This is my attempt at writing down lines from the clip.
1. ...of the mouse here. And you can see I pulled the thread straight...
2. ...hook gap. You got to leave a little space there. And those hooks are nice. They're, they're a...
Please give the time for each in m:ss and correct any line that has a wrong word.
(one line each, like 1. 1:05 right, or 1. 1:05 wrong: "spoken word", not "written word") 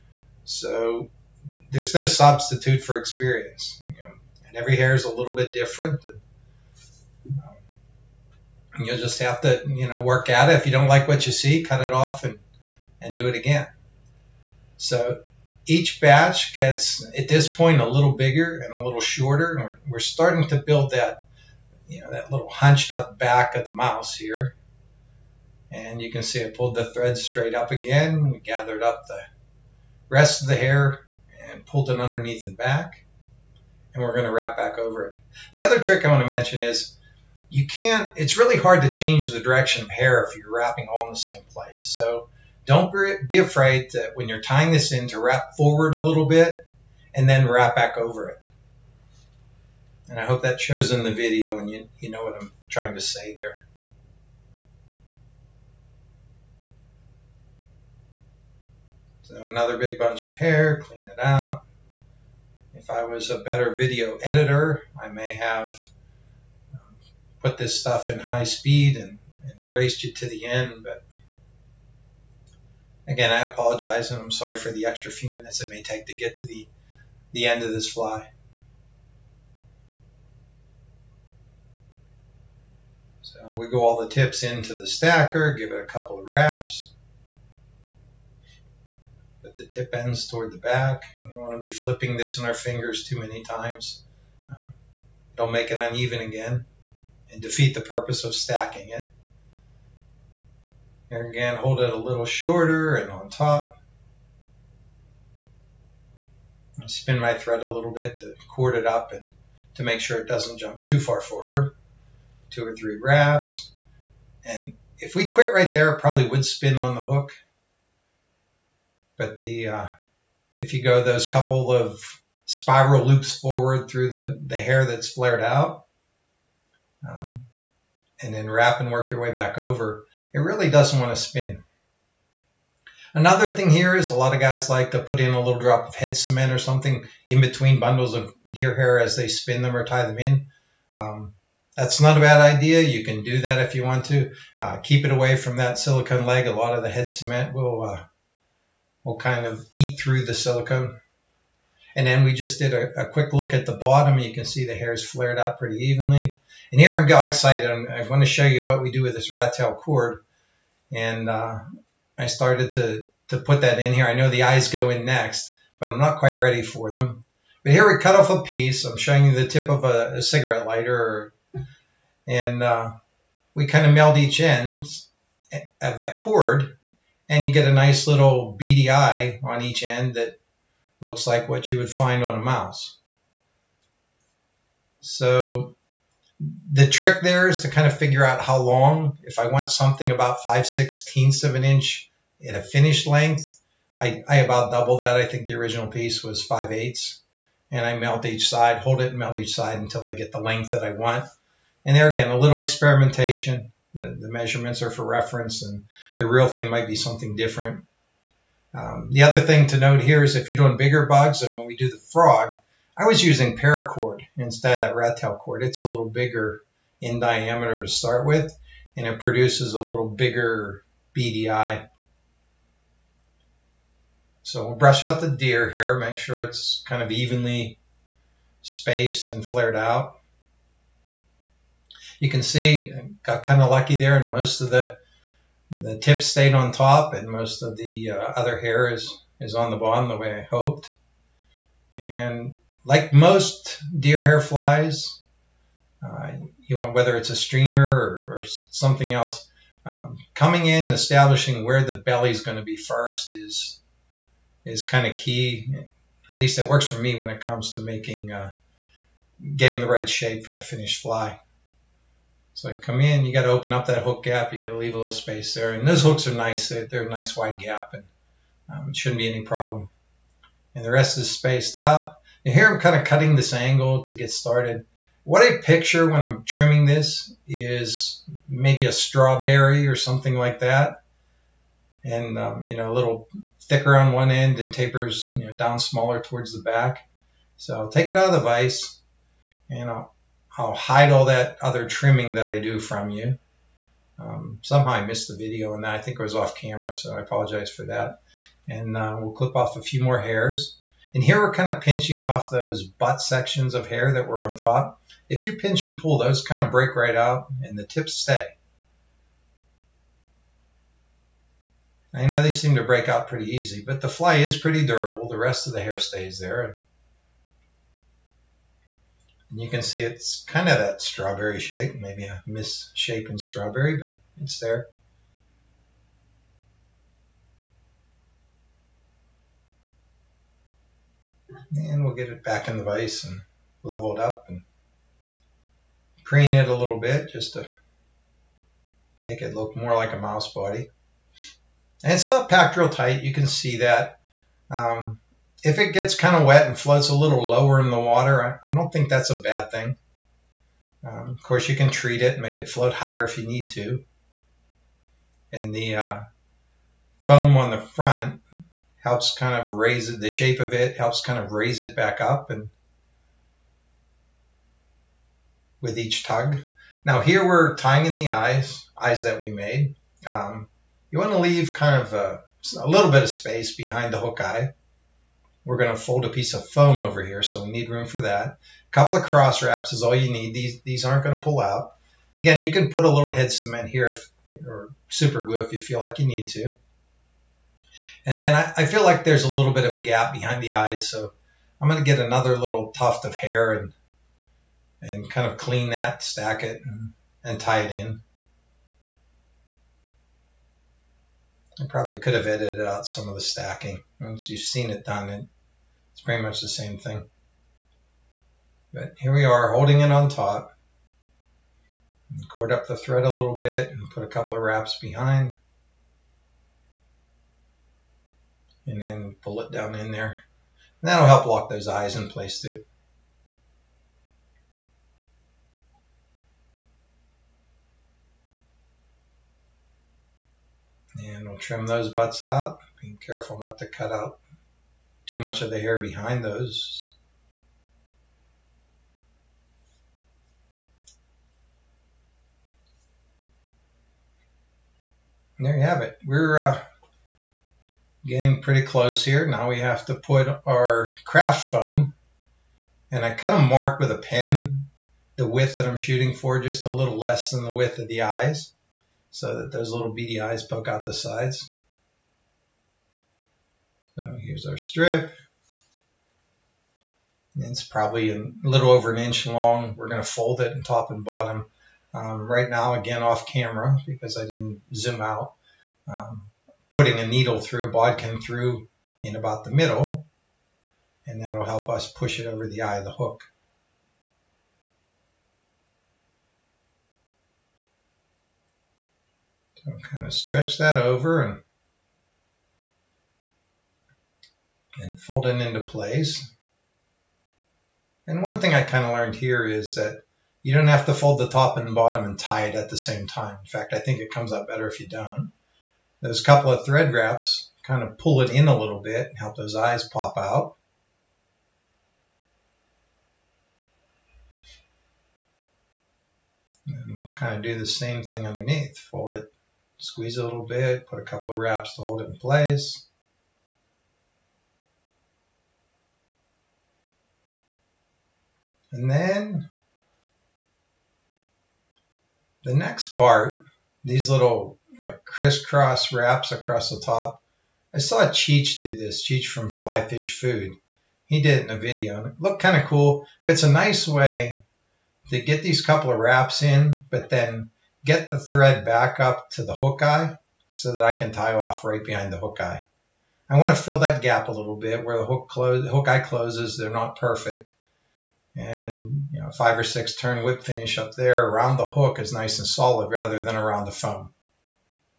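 1. 0:23 right
2. 4:24 right.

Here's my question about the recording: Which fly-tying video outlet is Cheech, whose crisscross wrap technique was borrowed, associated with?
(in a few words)
Fly Fish Food.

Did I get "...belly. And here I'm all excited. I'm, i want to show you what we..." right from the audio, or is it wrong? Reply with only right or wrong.
wrong.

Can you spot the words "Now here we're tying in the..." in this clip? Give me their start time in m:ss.
6:07.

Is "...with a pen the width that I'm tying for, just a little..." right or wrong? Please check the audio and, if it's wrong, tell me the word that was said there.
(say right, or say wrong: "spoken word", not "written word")
wrong: "shooting", not "tying".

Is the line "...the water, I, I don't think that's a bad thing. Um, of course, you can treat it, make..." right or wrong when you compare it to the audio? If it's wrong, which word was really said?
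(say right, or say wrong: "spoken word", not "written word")
right.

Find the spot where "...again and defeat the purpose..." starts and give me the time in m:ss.
1:36.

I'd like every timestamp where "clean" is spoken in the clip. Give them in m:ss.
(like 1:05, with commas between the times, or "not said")
1:00, 6:35.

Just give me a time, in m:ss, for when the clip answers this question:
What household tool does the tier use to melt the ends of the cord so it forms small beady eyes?
2:50.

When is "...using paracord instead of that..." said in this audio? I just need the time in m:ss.
3:33.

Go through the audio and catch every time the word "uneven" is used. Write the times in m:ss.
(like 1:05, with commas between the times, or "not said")
1:35.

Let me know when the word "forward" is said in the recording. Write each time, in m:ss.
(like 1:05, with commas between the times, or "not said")
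0:45, 1:51, 2:03.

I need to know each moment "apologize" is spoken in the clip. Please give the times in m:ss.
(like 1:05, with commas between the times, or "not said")
1:13, 4:57.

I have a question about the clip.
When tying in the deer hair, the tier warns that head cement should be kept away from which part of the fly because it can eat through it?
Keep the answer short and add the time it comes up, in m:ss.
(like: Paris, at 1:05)
silicone leg, at 2:25.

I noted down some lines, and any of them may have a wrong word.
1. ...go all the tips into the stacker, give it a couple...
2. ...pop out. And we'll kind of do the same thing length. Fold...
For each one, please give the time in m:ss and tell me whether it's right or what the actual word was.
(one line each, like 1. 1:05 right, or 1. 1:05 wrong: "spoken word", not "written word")
1. 1:23 right
2. 8:30 wrong: "underneath", not "length".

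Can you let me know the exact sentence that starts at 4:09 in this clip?
Um, coming in and establishing where the belly is going to be first is is kind of key.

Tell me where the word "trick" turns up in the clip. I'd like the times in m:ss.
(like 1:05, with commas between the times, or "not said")
0:35, 3:06.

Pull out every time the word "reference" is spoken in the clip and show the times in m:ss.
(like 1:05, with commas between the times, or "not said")
3:25.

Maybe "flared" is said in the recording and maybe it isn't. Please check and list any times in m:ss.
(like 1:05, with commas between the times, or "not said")
2:05, 2:35, 3:49.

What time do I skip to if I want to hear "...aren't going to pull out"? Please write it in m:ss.
6:21.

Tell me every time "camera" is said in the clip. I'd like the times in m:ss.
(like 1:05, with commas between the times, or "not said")
4:56, 7:53.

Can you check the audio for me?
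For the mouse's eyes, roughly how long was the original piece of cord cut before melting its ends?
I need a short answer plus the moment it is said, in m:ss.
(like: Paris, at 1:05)
5/8 inch, at 3:16.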